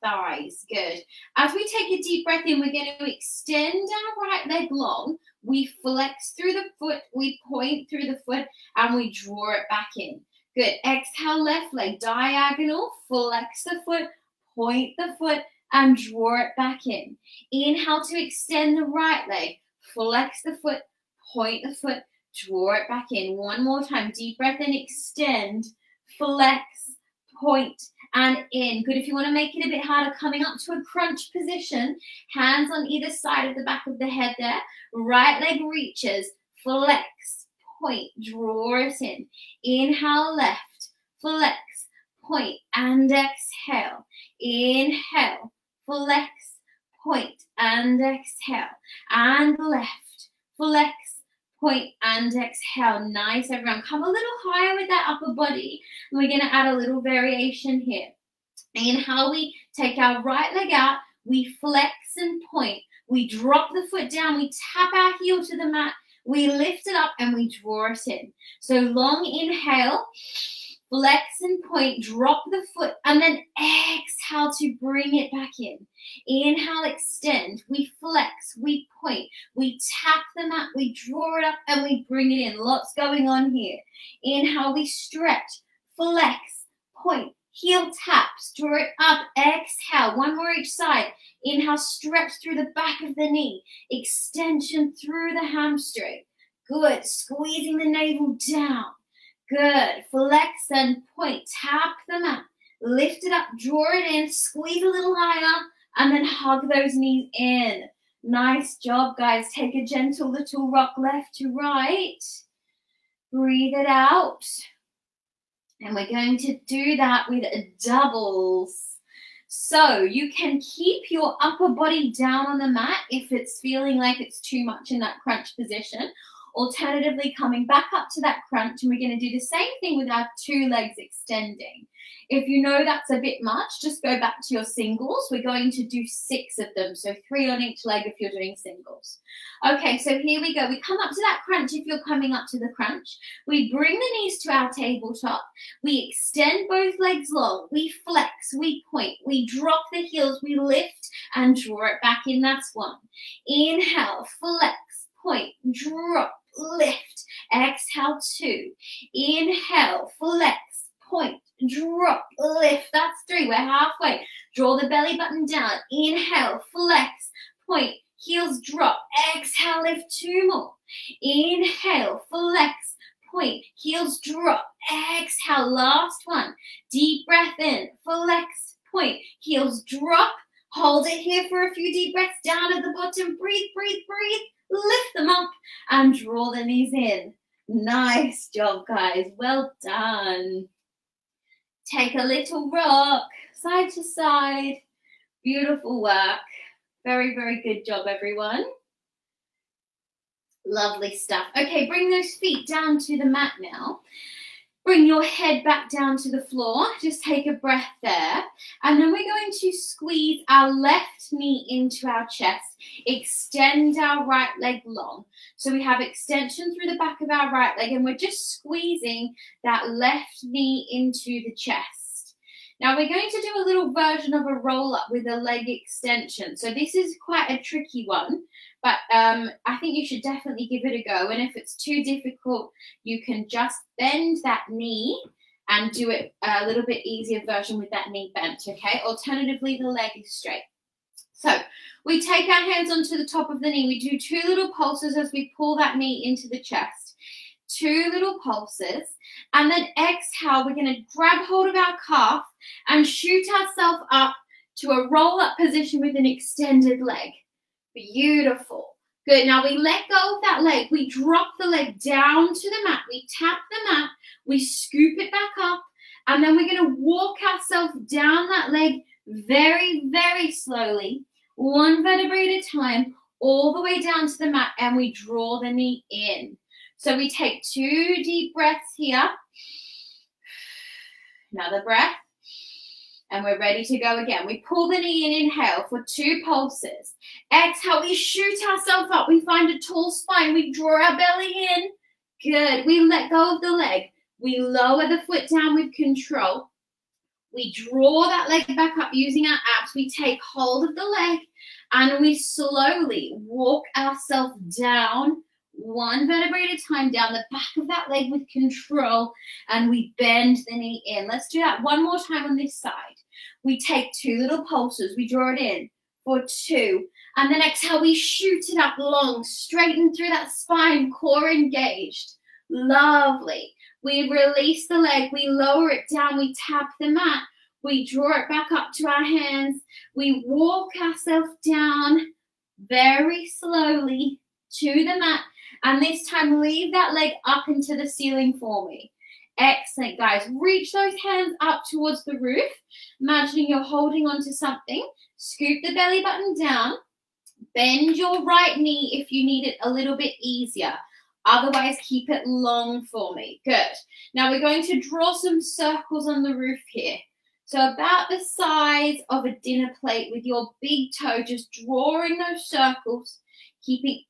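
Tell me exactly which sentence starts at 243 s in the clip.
We do two little pulses as we pull that knee into the chest.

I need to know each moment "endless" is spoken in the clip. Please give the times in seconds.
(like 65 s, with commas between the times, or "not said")
not said.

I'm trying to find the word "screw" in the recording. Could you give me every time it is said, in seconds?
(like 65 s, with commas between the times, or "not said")
not said.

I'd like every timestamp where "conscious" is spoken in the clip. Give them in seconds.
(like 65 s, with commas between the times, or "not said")
not said.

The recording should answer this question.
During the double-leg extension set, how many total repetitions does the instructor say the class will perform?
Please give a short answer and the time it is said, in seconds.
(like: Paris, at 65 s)
6, at 135 s.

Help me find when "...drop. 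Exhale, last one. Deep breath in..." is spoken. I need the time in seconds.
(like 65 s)
174 s.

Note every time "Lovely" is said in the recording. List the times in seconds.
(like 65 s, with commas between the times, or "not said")
200 s, 322 s.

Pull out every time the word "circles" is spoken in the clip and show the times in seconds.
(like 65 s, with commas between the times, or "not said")
355 s, 362 s.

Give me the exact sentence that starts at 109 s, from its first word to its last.
Take a gentle little rock left to right.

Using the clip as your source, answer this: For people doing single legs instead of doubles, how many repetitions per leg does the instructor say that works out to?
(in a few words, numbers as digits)
3.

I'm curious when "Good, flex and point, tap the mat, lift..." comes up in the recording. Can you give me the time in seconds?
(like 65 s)
99 s.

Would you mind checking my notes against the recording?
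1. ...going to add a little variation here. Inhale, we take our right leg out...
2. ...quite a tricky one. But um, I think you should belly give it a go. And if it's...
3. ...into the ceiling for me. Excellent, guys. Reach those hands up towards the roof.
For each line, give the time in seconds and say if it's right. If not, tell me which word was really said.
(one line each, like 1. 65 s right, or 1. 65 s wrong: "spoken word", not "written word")
1. 56 s right
2. 227 s wrong: "definitely", not "belly"
3. 337 s right.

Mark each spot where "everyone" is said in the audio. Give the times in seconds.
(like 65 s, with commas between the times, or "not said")
53 s, 198 s.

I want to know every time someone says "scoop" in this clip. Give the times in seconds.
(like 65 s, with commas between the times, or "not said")
264 s, 345 s.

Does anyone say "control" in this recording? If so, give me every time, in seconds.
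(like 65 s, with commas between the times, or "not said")
295 s, 308 s.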